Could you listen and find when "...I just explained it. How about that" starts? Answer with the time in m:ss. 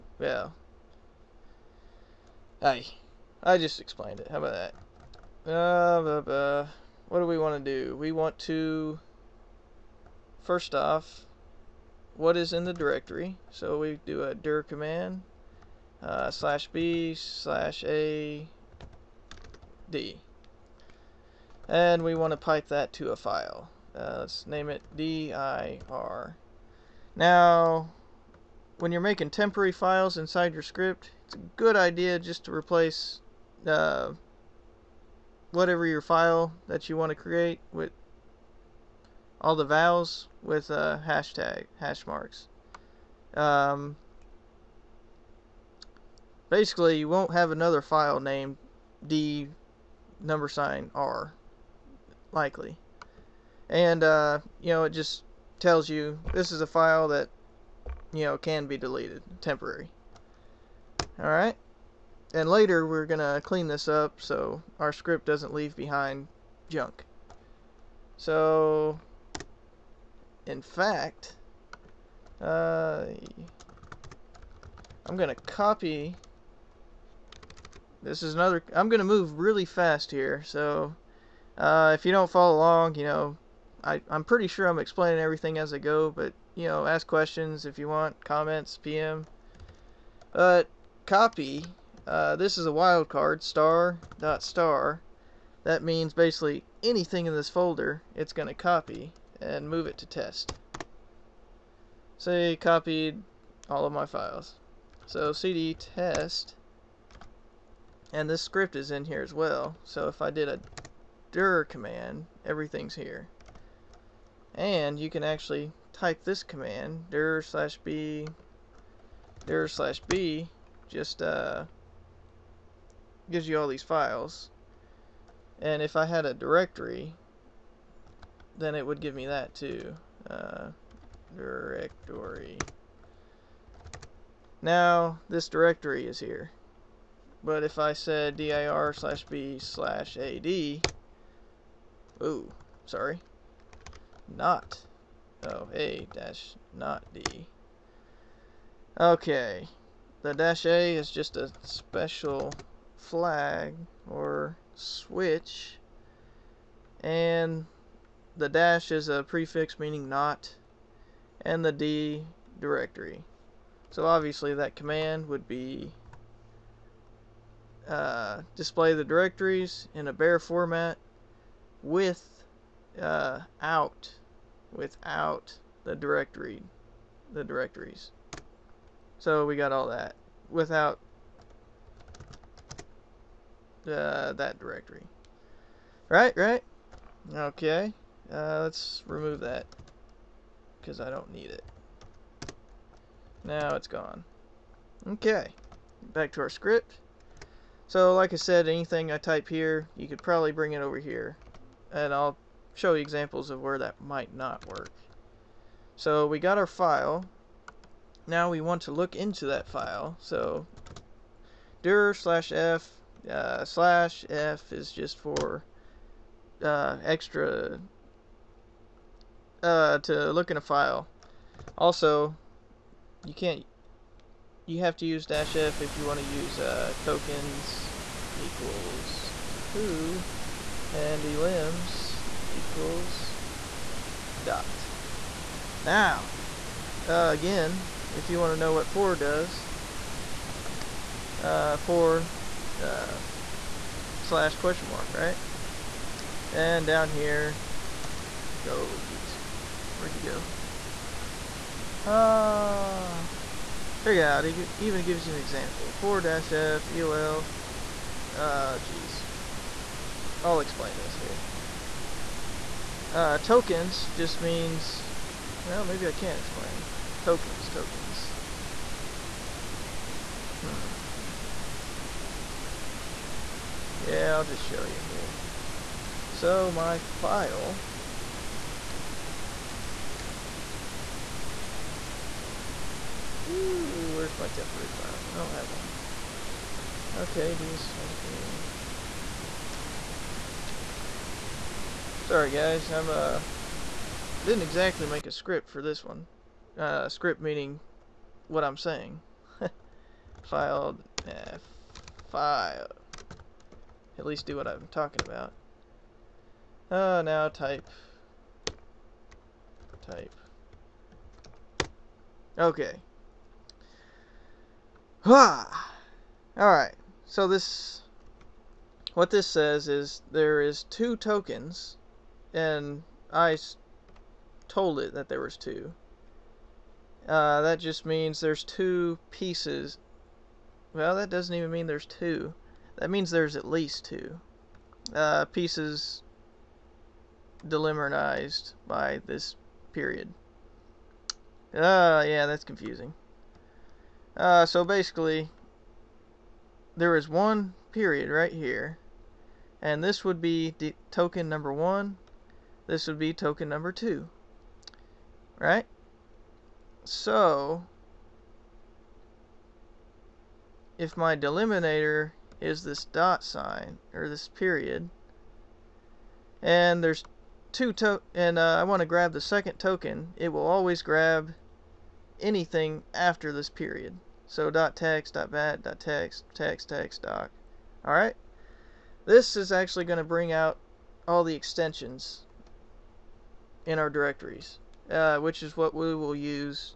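0:03.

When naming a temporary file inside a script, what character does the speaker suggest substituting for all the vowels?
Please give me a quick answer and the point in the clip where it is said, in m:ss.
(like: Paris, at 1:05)
hash marks, at 0:41.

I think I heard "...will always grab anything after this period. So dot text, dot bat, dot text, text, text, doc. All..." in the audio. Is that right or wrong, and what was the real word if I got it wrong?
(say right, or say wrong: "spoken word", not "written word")
right.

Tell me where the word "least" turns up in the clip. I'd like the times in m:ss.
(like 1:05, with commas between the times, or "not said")
5:04, 5:33.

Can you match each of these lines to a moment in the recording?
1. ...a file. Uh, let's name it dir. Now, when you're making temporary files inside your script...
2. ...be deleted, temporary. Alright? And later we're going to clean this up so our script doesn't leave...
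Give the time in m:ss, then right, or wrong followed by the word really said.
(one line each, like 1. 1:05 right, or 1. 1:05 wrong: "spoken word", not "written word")
1. 0:23 right
2. 0:58 right.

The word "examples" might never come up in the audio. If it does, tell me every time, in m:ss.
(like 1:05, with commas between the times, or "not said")
3:23, 4:15.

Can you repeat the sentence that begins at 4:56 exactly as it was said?
Uh script meaning what I'm saying.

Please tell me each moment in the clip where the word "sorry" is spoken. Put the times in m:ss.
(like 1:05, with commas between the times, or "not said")
2:22, 4:52.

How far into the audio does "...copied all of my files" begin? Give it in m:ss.
1:42.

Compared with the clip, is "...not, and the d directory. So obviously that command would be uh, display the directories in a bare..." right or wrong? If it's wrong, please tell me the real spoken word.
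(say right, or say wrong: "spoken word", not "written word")
right.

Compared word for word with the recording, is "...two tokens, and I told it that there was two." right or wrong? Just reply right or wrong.
right.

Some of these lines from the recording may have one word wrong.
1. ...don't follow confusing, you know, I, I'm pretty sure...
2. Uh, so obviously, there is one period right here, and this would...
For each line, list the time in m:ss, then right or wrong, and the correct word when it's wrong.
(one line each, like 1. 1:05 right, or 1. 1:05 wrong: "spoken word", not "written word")
1. 1:22 wrong: "along", not "confusing"
2. 5:44 wrong: "basically", not "obviously".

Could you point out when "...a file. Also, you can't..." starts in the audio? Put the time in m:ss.
3:40.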